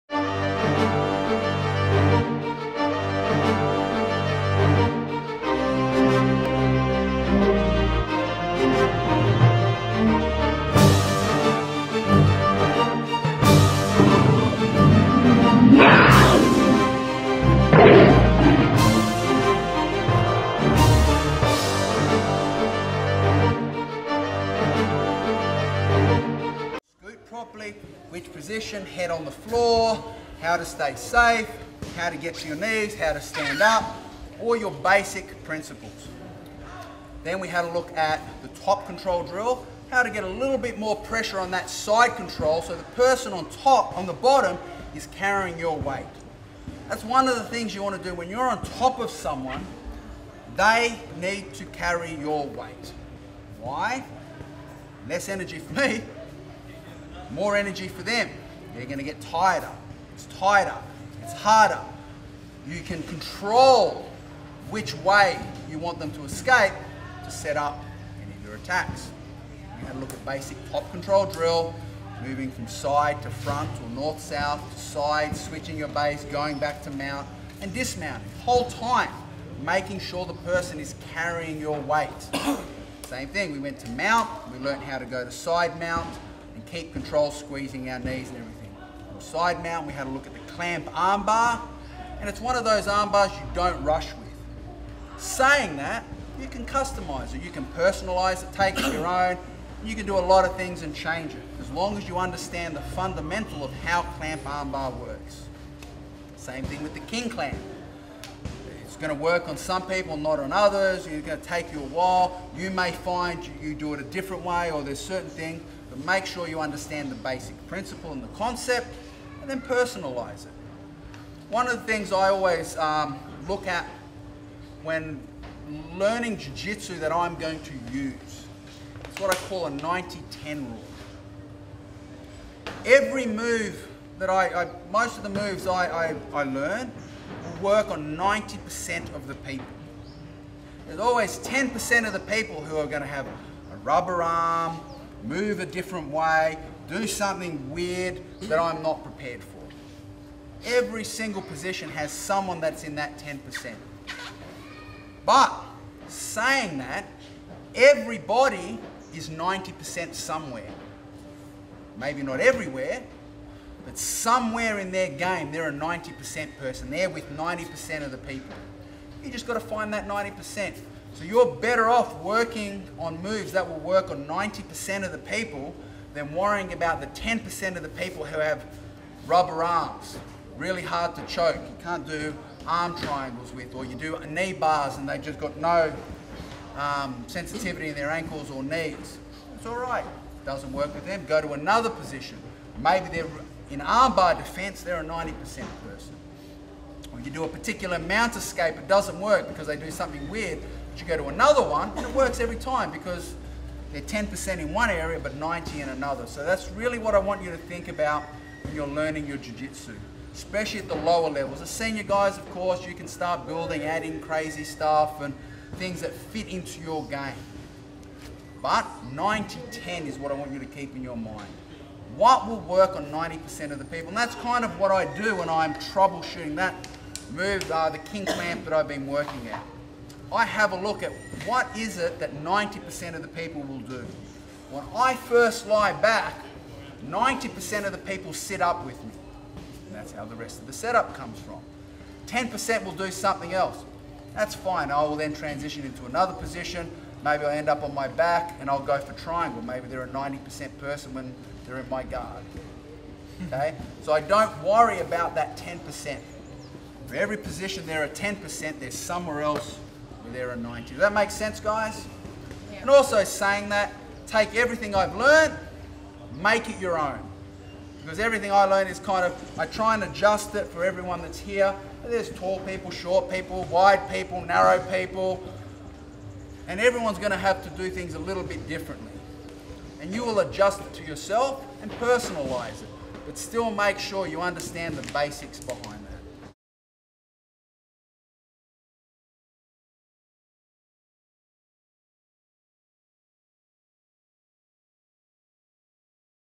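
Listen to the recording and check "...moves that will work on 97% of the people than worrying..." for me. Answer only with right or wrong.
wrong.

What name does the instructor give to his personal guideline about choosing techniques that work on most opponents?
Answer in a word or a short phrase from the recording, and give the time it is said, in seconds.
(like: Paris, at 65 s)
90-10 rule, at 129 s.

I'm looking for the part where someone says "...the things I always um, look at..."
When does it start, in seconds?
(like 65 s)
121 s.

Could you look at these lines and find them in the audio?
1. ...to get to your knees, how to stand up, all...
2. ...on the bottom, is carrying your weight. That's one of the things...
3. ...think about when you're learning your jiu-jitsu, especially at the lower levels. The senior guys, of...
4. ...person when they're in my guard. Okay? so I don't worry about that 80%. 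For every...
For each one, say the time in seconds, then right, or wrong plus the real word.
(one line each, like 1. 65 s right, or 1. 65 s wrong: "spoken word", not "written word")
1. 32 s right
2. 43 s right
3. 207 s right
4. 250 s wrong: "10", not "80".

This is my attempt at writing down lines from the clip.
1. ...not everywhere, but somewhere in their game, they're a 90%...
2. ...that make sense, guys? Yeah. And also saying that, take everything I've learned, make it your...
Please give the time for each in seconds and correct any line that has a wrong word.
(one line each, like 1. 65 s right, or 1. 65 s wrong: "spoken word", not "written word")
1. 162 s right
2. 260 s right.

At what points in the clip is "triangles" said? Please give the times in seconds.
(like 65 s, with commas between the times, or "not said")
182 s, 249 s.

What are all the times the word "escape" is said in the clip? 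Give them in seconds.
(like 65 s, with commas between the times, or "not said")
66 s, 198 s.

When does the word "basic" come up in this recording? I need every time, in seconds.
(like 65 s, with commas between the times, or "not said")
34 s, 70 s, 117 s, 285 s.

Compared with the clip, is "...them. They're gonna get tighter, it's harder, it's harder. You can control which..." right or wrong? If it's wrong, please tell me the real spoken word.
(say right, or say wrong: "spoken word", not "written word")
wrong: "tighter", not "harder".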